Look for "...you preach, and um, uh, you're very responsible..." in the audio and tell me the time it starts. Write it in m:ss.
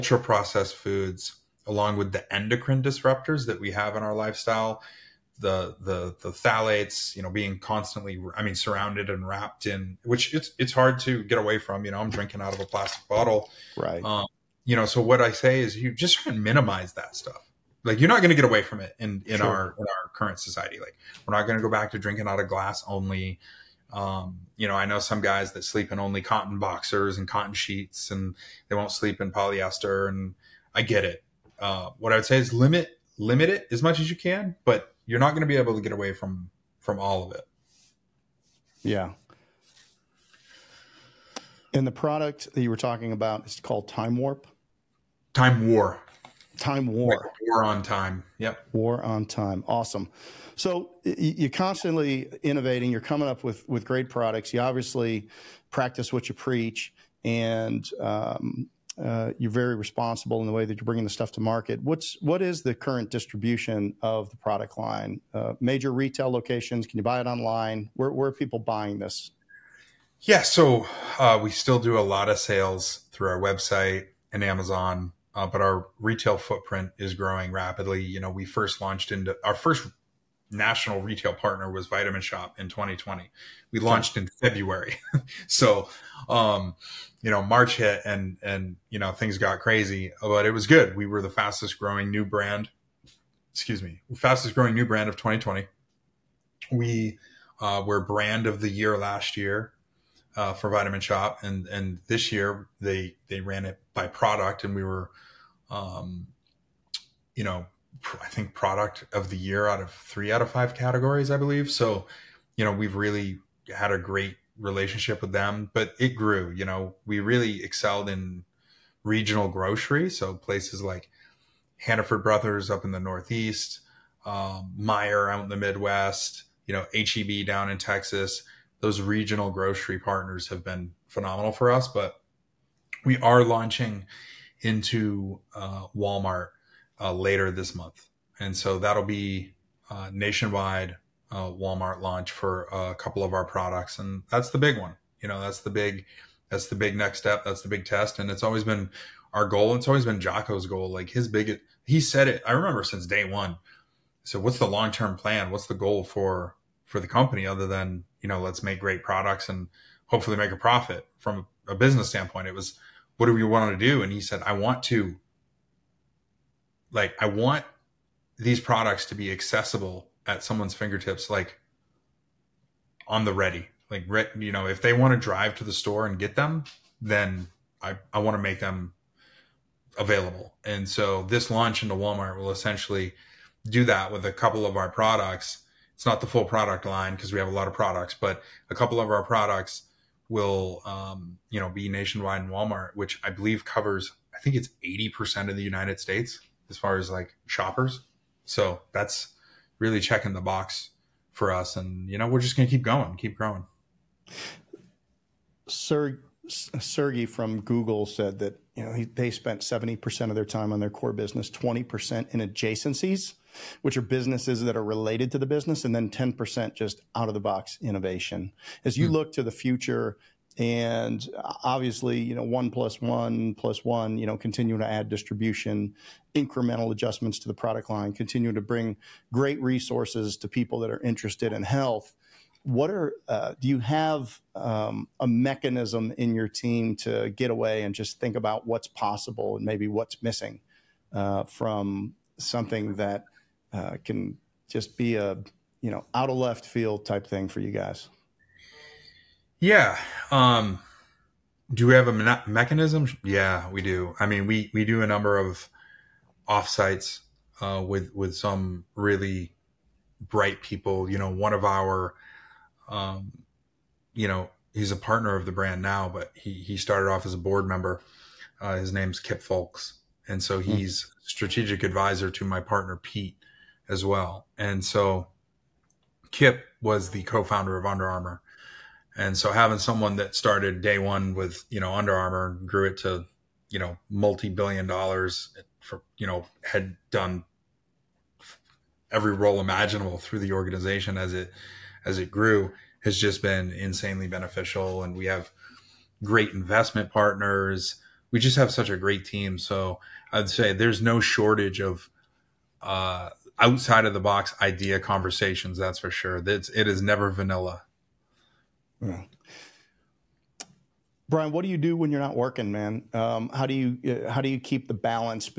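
0:56.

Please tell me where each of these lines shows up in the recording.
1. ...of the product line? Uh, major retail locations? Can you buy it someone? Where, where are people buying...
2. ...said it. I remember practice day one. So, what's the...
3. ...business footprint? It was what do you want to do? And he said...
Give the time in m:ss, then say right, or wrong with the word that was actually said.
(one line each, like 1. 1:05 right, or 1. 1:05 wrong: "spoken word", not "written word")
1. 1:04 wrong: "online", not "someone"
2. 2:31 wrong: "since", not "practice"
3. 2:41 wrong: "standpoint", not "footprint".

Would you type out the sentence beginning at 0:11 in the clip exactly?
You know, I'm drinking out of a plastic bottle, right?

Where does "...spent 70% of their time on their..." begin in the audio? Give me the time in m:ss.
3:29.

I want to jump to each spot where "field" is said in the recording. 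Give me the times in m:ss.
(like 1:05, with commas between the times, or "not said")
4:06.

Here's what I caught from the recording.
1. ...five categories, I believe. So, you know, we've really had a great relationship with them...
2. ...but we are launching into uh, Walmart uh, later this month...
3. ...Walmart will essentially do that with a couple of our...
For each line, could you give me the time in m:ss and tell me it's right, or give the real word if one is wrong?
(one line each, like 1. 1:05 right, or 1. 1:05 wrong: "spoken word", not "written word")
1. 1:50 right
2. 2:11 right
3. 3:01 right.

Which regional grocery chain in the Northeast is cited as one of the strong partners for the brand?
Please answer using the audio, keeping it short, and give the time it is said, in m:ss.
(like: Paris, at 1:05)
Hannaford Brothers, at 2:01.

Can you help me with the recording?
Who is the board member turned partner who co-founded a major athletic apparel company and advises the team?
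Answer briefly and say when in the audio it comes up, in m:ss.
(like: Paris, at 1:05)
Kip Fulks, at 4:29.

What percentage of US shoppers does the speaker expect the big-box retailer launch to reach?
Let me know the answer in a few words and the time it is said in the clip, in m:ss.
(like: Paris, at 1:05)
80%, at 3:14.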